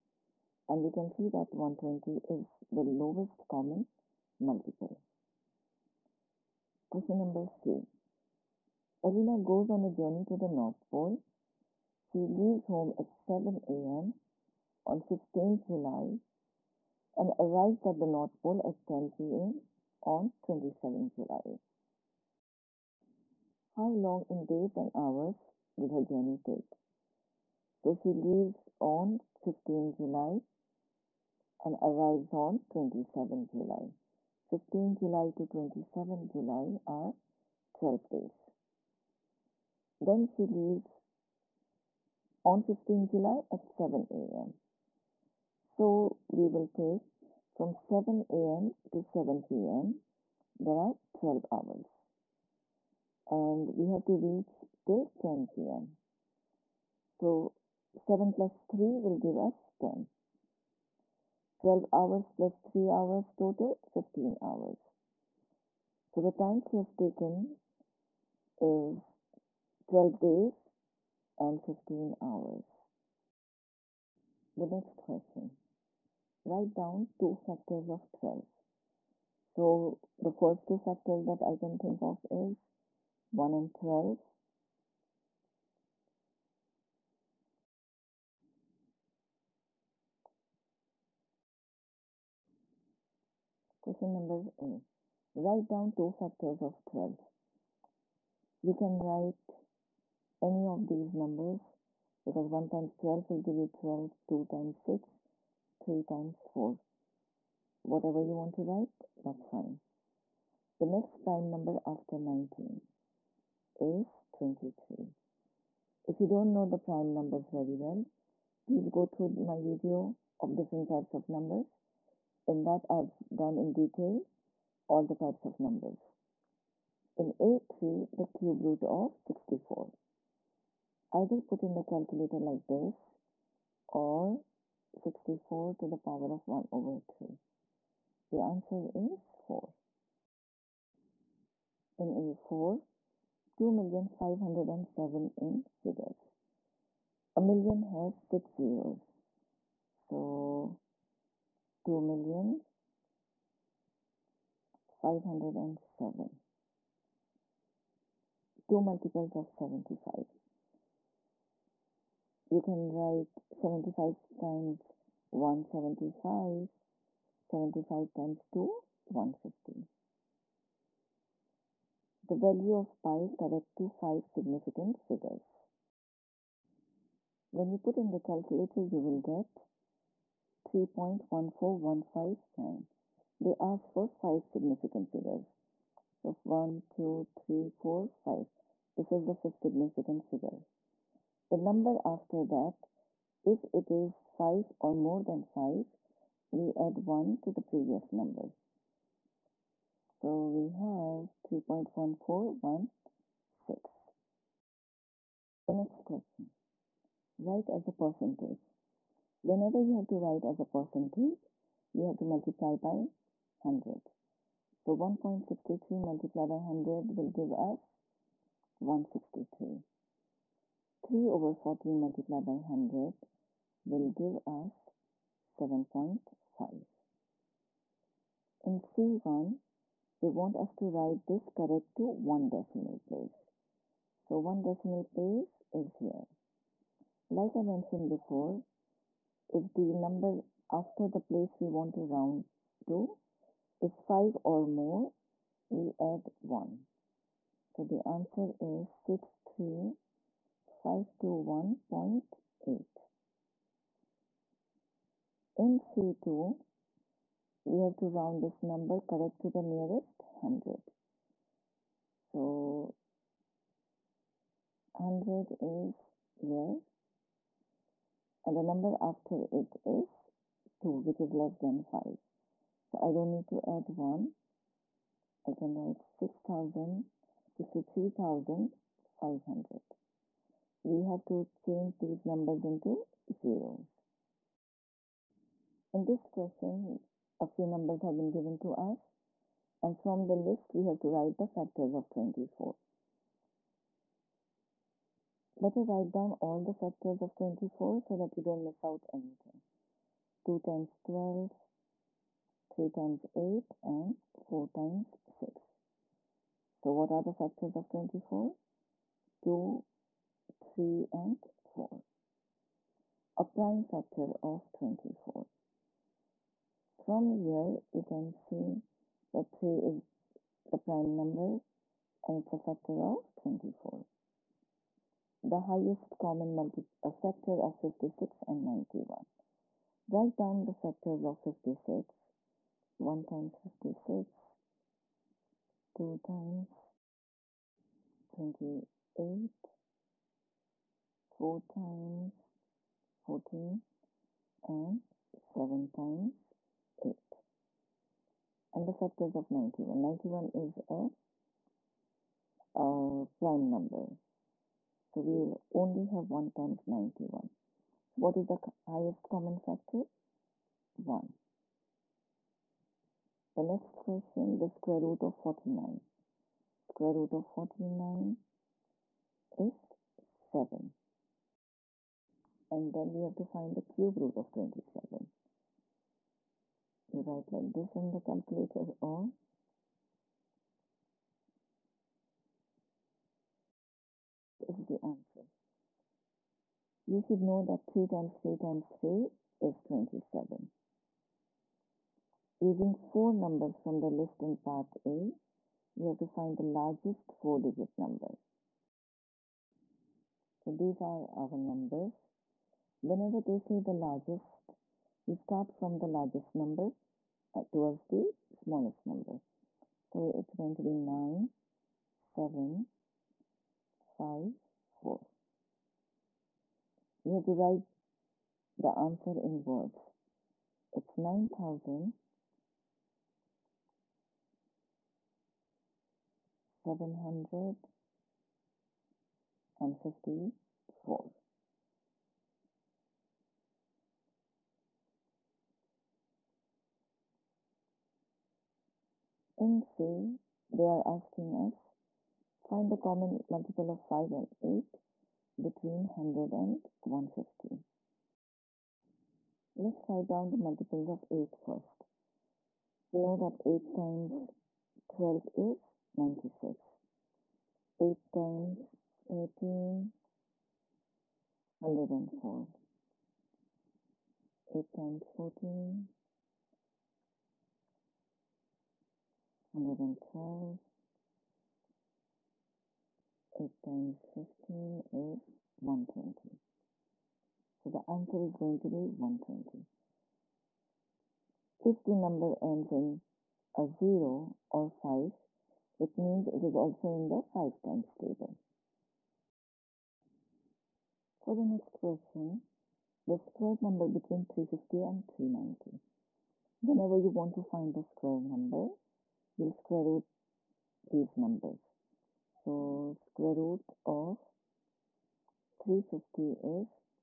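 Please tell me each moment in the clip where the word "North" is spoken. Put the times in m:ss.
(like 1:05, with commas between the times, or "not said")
0:10, 0:18.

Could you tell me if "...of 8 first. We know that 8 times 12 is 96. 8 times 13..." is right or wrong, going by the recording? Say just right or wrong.
right.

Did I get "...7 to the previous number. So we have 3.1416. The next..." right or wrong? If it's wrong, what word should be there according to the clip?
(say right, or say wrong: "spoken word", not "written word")
wrong: "1", not "7".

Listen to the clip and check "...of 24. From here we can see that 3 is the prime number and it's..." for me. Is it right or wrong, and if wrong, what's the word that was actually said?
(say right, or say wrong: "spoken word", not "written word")
right.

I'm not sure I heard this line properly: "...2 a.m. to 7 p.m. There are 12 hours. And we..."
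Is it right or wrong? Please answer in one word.
wrong.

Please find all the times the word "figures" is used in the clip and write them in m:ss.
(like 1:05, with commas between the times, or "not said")
2:25, 2:54, 3:05, 3:10.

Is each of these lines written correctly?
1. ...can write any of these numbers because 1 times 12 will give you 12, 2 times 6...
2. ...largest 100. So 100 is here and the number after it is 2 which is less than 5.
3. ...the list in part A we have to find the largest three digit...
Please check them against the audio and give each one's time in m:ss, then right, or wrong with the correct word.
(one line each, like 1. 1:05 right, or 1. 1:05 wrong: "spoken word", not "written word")
1. 1:38 right
2. 4:19 wrong: "nearest", not "largest"
3. 6:33 wrong: "four", not "three".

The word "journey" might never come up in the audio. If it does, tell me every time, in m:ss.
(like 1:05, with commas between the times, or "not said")
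0:09, 0:26.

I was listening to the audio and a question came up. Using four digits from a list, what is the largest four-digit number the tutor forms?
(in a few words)
9754.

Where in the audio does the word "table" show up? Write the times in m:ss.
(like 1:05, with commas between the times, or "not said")
8:08.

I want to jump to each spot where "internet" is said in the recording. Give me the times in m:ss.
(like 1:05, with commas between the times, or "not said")
not said.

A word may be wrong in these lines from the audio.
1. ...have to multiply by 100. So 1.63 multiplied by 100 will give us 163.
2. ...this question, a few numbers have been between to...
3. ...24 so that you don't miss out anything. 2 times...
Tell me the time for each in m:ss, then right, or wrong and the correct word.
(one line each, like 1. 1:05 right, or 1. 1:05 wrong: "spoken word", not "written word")
1. 3:32 right
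2. 4:46 wrong: "given", not "between"
3. 4:57 right.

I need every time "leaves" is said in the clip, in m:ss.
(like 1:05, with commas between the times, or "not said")
0:12, 0:28, 0:40.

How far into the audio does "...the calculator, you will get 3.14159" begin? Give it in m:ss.
2:58.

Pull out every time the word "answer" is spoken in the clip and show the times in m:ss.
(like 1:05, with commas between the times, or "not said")
2:18, 4:08, 6:25, 6:58, 7:58.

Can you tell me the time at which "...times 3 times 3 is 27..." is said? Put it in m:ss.
6:28.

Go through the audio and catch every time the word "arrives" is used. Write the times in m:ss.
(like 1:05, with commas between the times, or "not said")
0:17, 0:31.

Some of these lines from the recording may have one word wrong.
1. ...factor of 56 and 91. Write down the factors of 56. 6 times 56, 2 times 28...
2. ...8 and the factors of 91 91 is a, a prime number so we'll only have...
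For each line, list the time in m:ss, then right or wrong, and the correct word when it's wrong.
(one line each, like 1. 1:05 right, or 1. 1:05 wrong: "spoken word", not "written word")
1. 5:27 wrong: "1", not "6"
2. 5:46 right.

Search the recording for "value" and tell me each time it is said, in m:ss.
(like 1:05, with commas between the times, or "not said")
2:52.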